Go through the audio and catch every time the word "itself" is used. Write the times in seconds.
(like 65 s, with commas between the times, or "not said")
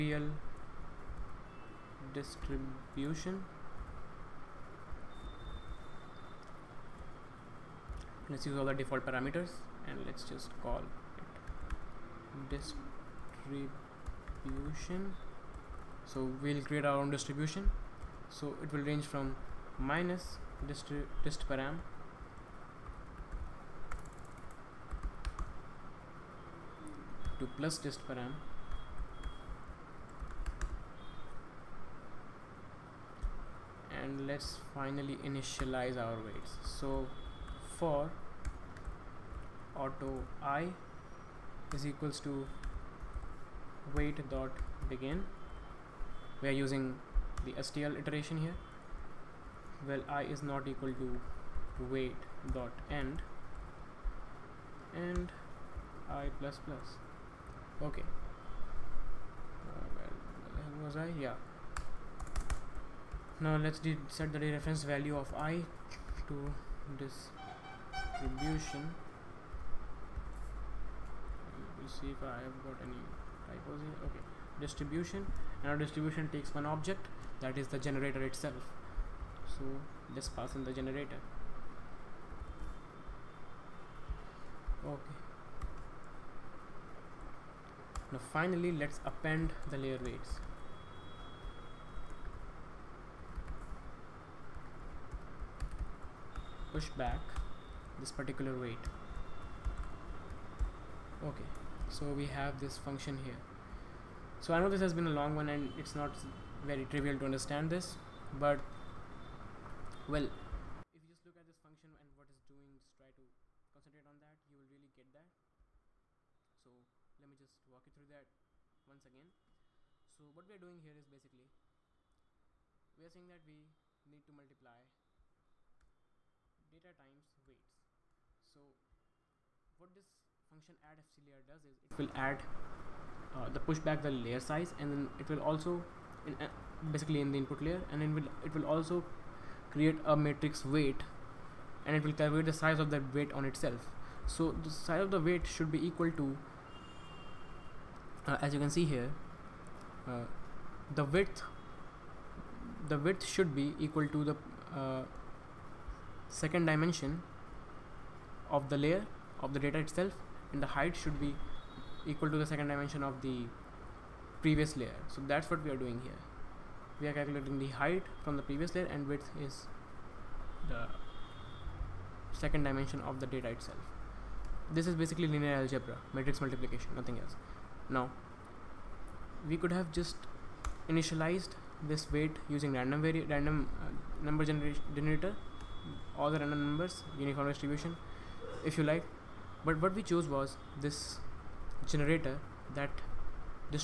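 78 s, 143 s, 159 s, 173 s.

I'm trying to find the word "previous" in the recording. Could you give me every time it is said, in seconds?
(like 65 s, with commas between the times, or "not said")
164 s, 168 s.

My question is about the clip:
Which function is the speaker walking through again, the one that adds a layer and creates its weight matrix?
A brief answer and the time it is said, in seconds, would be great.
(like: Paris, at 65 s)
add fc layer, at 130 s.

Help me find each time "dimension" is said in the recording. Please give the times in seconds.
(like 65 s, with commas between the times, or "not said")
156 s, 162 s, 172 s.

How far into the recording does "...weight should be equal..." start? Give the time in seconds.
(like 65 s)
145 s.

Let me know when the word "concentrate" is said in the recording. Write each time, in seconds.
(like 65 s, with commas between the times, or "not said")
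113 s.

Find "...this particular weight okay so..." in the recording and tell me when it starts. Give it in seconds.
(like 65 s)
97 s.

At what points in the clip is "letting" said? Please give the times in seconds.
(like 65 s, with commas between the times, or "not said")
not said.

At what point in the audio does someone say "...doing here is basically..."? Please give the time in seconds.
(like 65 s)
120 s.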